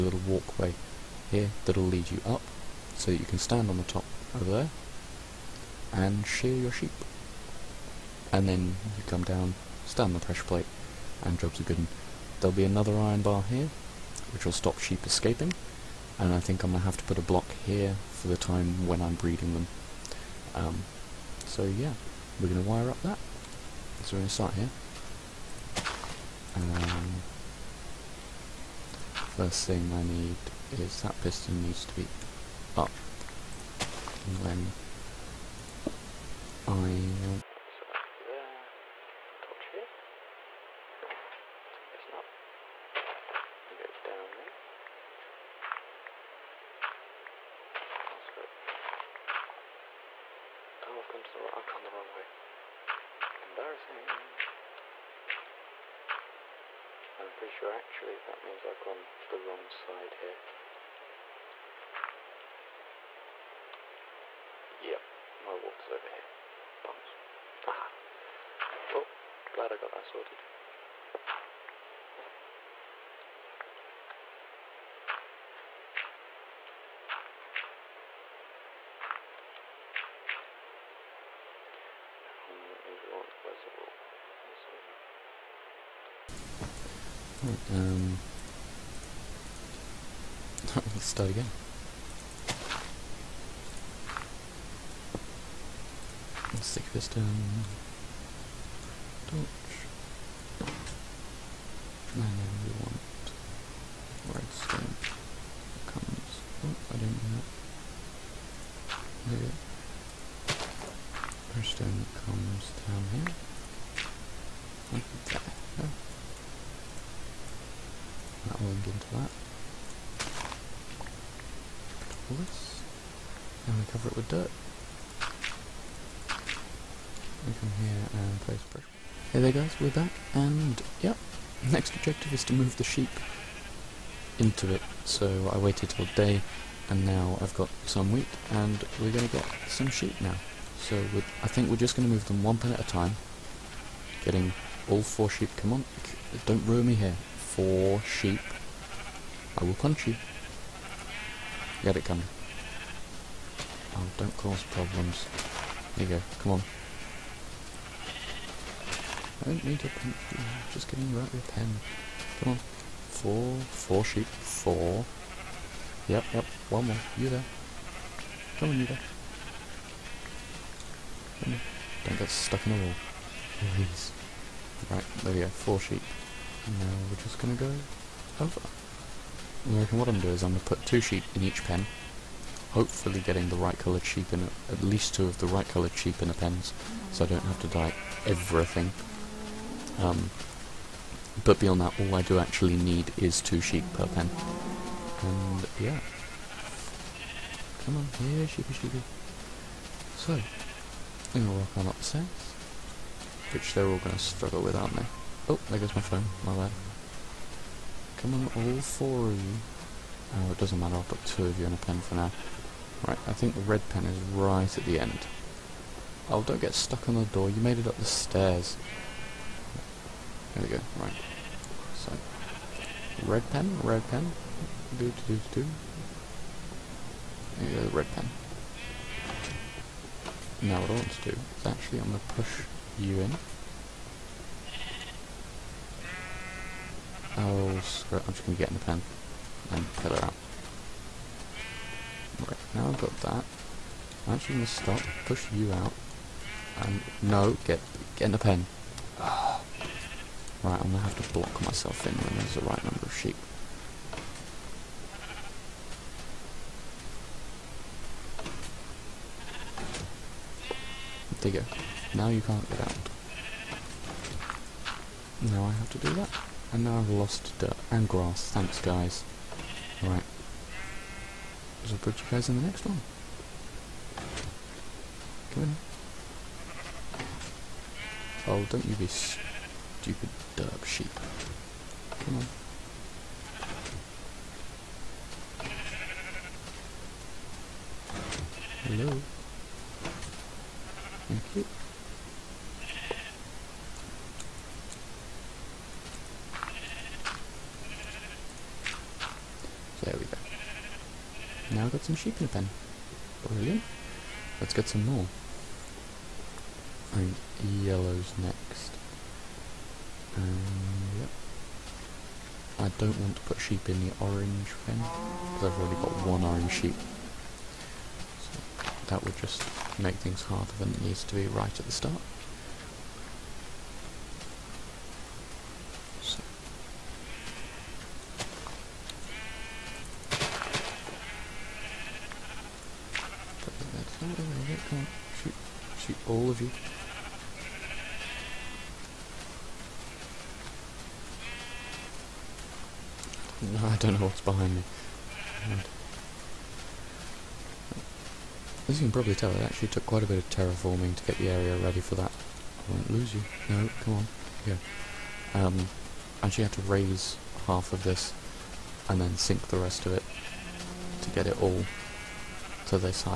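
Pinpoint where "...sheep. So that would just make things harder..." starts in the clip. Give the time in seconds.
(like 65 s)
316 s.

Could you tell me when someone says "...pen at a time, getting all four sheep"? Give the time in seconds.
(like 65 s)
142 s.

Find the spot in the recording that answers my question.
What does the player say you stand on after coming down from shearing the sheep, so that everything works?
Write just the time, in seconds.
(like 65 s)
10 s.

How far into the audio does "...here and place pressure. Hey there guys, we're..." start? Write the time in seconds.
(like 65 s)
127 s.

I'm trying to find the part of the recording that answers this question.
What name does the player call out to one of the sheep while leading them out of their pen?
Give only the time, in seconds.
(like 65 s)
152 s.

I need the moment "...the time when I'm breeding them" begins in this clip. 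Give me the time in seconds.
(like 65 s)
18 s.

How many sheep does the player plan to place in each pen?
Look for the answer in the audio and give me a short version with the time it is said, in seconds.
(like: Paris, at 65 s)
2, at 193 s.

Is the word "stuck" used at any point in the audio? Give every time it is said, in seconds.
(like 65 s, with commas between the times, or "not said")
172 s, 216 s.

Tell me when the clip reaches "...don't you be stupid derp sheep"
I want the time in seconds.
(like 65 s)
278 s.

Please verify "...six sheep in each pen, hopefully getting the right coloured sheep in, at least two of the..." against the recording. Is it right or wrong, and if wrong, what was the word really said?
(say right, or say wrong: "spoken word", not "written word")
wrong: "two", not "six".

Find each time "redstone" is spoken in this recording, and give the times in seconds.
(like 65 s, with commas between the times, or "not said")
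104 s, 111 s.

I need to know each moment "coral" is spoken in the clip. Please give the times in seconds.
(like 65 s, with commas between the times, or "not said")
not said.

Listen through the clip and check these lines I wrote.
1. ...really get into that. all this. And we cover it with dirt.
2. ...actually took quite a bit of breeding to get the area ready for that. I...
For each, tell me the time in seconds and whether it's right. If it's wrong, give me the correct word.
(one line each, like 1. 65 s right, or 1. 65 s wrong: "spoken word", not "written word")
1. 118 s right
2. 349 s wrong: "terraforming", not "breeding".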